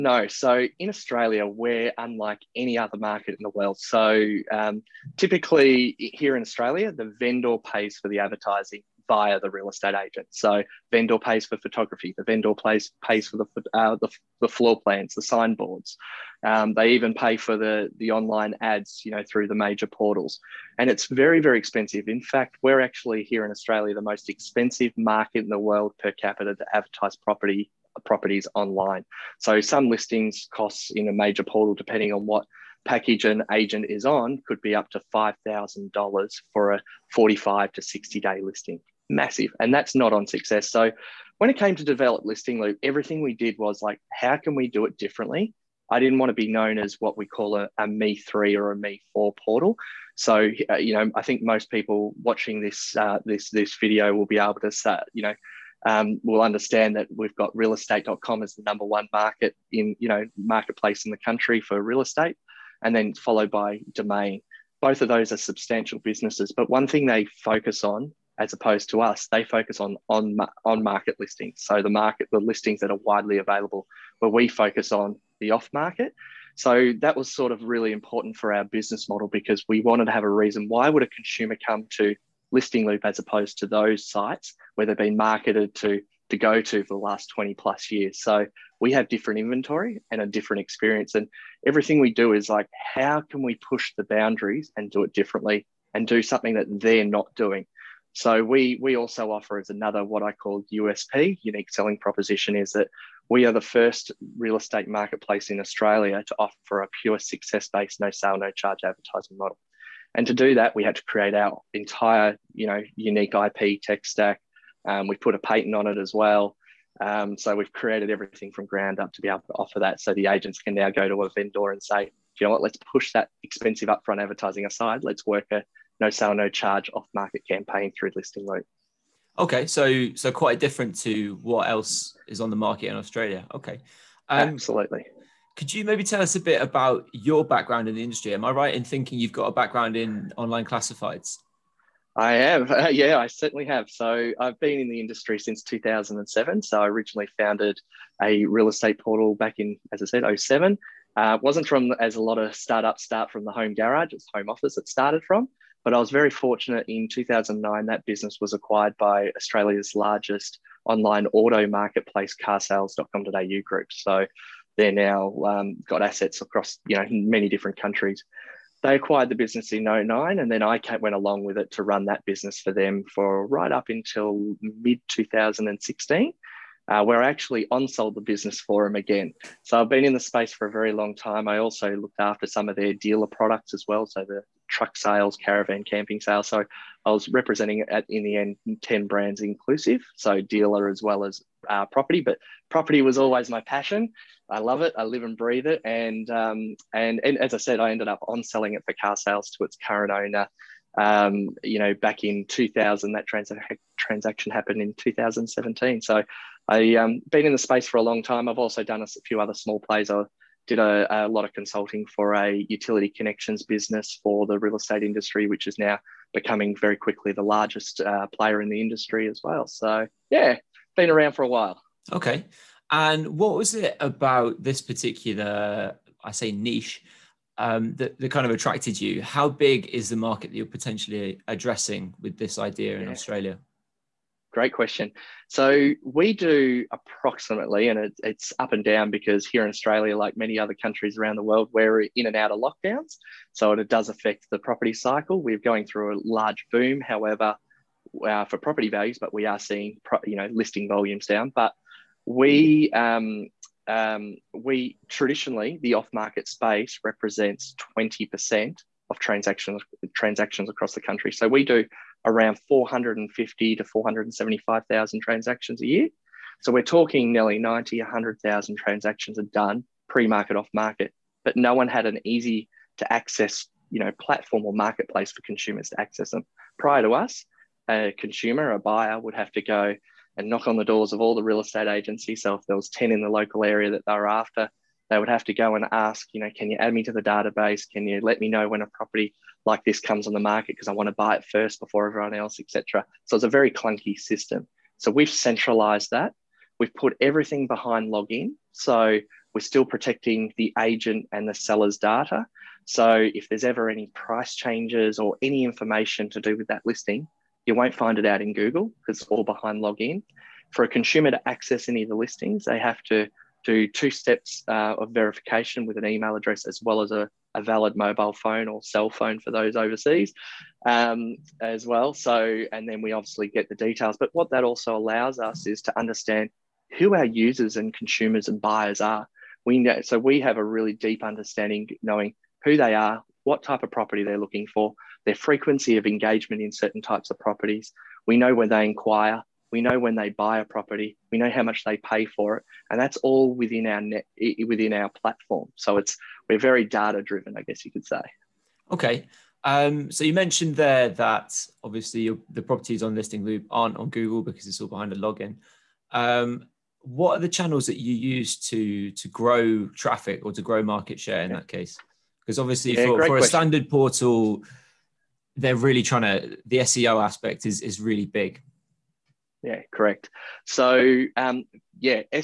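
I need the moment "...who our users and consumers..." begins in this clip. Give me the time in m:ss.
5:26.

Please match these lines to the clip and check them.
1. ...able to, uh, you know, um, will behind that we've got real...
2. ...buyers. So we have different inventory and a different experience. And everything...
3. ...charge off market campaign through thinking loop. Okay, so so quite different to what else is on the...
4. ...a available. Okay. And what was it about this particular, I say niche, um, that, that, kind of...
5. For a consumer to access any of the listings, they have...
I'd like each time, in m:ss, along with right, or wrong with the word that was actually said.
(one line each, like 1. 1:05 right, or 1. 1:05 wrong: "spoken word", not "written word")
1. 0:54 wrong: "understand", not "behind"
2. 1:27 wrong: "years", not "buyers"
3. 2:06 wrong: "listing", not "thinking"
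4. 3:41 wrong: "while", not "available"
5. 5:10 right.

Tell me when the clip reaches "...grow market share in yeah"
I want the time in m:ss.
6:00.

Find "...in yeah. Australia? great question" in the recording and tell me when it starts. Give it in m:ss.
3:52.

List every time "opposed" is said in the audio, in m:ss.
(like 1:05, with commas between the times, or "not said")
1:08, 1:23.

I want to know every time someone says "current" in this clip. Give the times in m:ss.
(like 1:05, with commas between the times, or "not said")
3:19.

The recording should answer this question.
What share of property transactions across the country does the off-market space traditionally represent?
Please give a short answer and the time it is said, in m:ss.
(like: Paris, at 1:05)
20 percent, at 4:17.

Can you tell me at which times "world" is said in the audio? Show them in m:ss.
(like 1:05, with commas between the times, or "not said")
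0:03, 0:25, 4:01.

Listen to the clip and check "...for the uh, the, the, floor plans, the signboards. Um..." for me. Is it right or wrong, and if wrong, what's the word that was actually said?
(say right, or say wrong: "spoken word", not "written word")
right.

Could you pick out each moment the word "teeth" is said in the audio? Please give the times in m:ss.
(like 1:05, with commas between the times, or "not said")
not said.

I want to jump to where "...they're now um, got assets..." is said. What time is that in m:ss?
2:44.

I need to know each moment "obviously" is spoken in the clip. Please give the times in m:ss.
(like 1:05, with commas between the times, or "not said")
5:23, 5:51, 6:02.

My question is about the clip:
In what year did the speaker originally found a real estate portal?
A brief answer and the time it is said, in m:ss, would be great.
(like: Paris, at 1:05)
2007, at 2:25.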